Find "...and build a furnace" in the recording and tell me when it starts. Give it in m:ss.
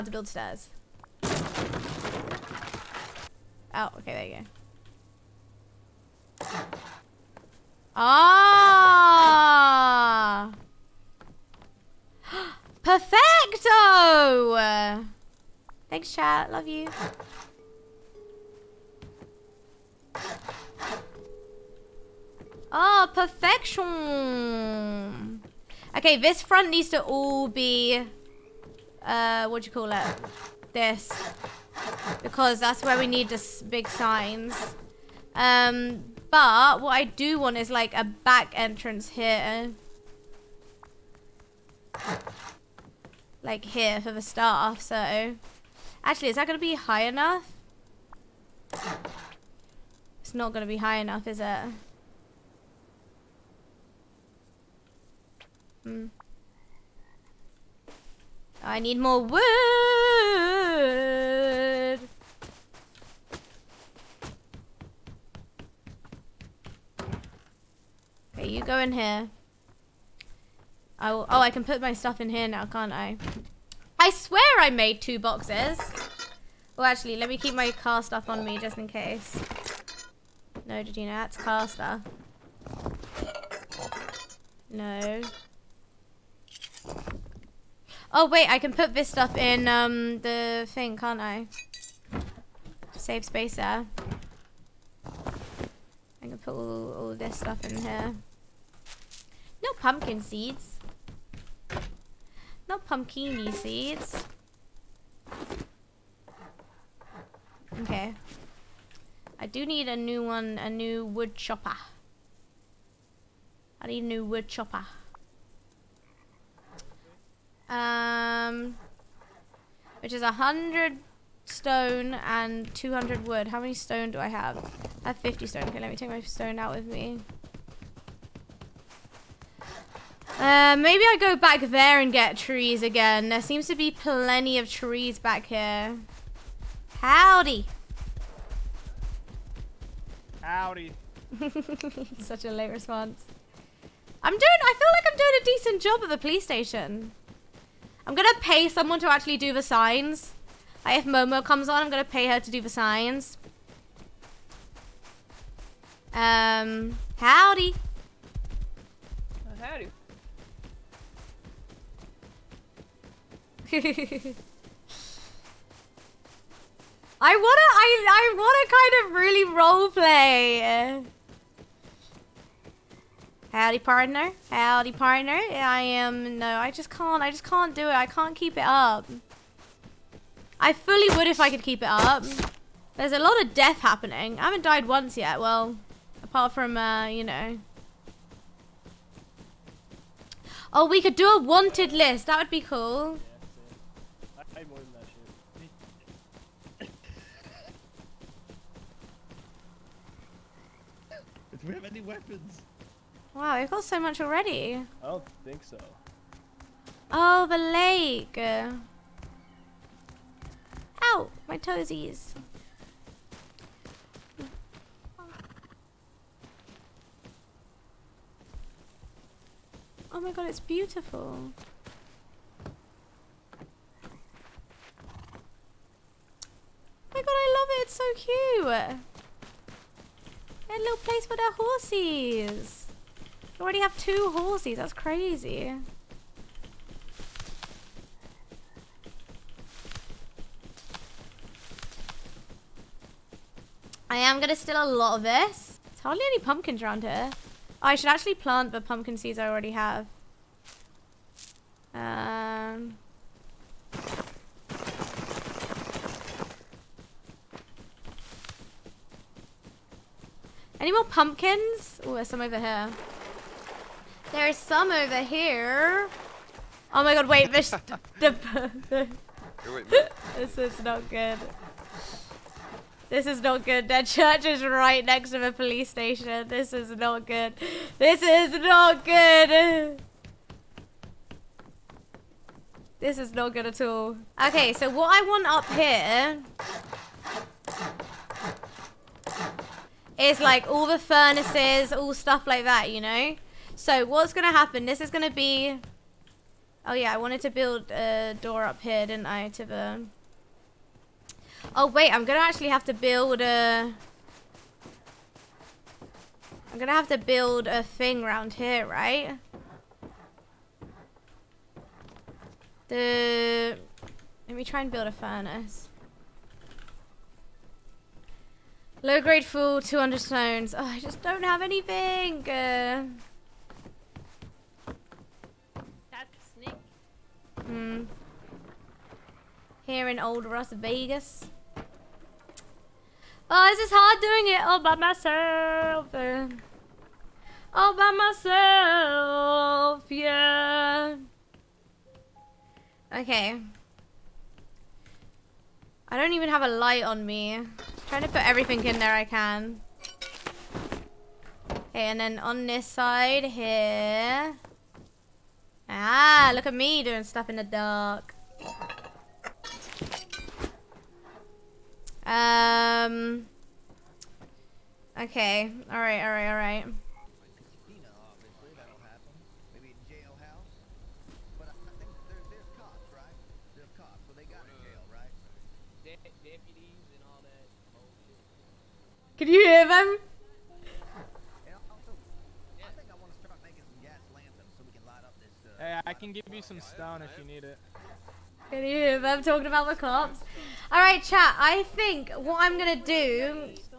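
5:14.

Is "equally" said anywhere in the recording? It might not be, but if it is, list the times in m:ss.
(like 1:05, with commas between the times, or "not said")
not said.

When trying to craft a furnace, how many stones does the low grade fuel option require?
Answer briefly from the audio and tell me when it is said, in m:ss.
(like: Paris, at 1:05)
200, at 5:19.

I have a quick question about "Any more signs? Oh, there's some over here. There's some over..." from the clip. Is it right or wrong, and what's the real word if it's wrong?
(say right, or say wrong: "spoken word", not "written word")
wrong: "pumpkins", not "signs".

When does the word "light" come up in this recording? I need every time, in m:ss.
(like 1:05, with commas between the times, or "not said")
5:46.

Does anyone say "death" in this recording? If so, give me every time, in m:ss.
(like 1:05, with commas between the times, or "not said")
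3:03.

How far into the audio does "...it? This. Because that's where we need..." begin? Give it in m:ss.
0:29.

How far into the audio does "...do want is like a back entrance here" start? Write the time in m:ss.
0:37.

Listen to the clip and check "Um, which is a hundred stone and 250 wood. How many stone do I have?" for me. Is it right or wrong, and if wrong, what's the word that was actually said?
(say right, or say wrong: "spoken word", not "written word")
wrong: "200", not "250".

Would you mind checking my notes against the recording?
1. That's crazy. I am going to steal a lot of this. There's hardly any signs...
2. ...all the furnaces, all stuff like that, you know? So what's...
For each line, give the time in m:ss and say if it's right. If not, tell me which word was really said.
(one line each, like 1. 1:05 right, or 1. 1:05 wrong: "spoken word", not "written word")
1. 3:54 wrong: "pumpkins", not "signs"
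2. 4:50 right.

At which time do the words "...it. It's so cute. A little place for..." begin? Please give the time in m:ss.
3:47.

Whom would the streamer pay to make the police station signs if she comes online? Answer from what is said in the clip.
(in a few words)
Momo.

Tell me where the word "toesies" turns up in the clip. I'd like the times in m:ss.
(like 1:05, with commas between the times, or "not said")
3:31.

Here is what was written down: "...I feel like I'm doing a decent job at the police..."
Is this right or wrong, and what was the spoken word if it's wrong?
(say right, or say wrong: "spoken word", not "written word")
right.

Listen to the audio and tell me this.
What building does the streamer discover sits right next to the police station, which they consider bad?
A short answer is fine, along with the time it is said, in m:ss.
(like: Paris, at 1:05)
church, at 4:34.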